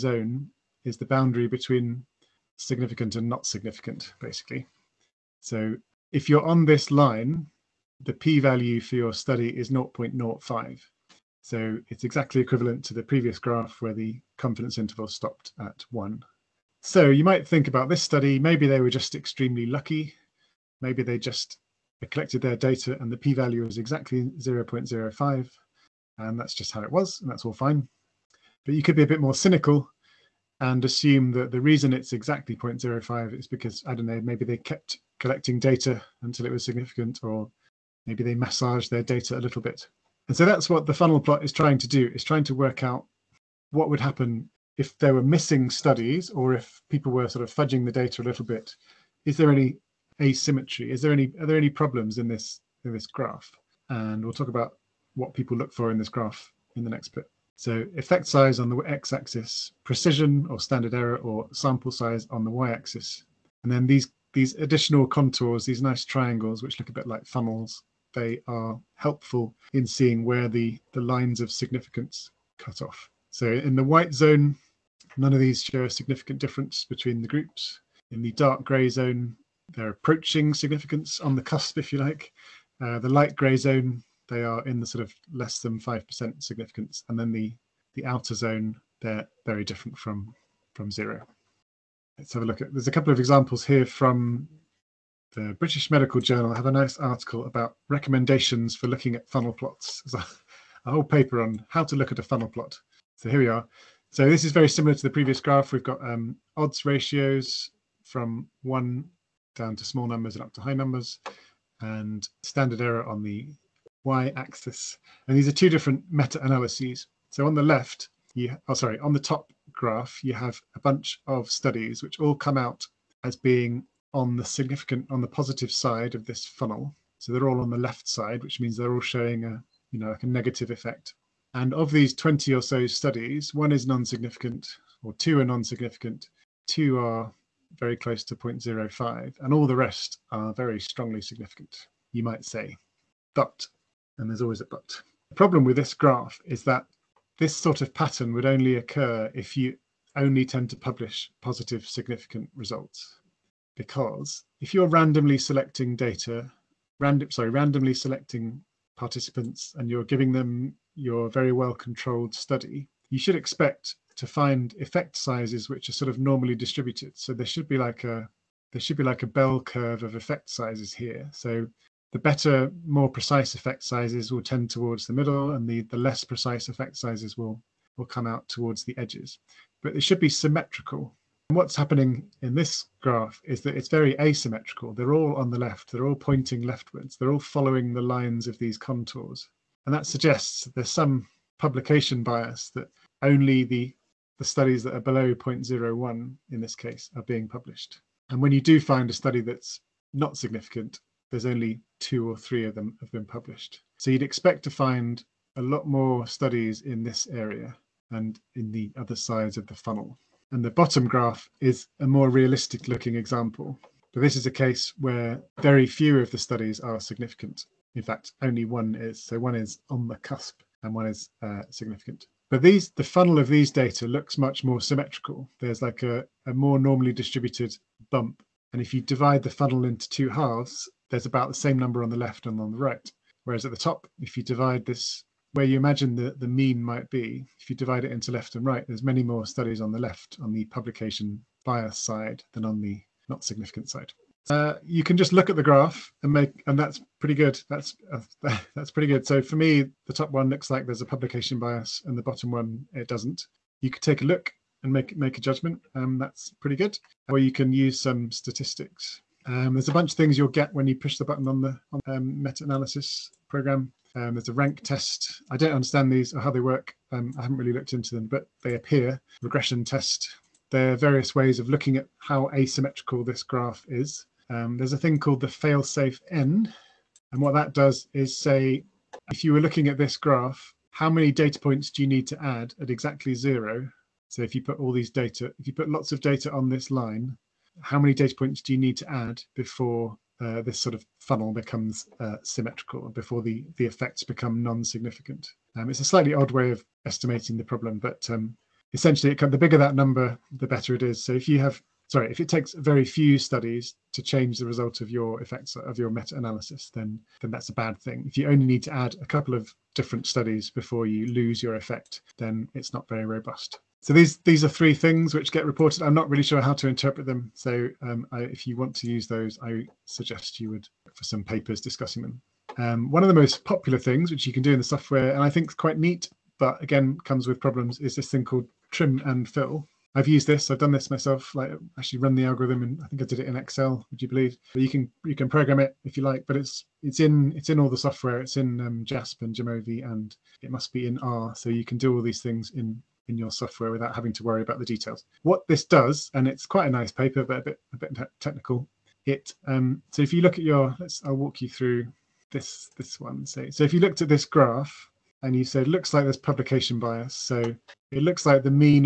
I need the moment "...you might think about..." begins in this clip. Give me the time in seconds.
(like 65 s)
17 s.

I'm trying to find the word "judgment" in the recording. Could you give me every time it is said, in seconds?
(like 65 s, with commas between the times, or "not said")
255 s.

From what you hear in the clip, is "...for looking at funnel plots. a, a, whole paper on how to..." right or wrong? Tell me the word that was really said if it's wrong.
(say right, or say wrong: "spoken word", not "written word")
right.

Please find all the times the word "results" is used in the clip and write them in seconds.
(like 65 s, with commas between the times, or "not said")
152 s, 304 s.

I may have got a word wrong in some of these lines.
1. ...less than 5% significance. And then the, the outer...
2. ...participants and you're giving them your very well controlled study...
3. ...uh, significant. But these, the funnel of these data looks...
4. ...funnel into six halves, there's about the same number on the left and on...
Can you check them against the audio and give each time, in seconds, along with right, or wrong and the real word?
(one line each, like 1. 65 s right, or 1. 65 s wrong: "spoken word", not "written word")
1. 85 s right
2. 158 s right
3. 221 s right
4. 229 s wrong: "two", not "six".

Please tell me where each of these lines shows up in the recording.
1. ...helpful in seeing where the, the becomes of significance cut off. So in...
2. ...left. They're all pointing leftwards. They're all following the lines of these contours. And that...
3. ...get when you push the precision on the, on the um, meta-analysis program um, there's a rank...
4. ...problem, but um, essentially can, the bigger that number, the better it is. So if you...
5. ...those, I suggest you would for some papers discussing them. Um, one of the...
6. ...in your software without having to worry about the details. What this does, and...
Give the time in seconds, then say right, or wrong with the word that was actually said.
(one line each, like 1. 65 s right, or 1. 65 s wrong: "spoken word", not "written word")
1. 68 s wrong: "lines", not "becomes"
2. 185 s right
3. 260 s wrong: "button", not "precision"
4. 297 s right
5. 319 s right
6. 343 s right.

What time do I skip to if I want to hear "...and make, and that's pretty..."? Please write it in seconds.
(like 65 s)
246 s.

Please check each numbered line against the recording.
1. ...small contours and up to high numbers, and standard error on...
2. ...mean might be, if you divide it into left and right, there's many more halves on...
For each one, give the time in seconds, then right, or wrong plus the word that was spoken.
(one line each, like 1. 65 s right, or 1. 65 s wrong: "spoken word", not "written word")
1. 109 s wrong: "numbers", not "contours"
2. 236 s wrong: "studies", not "halves".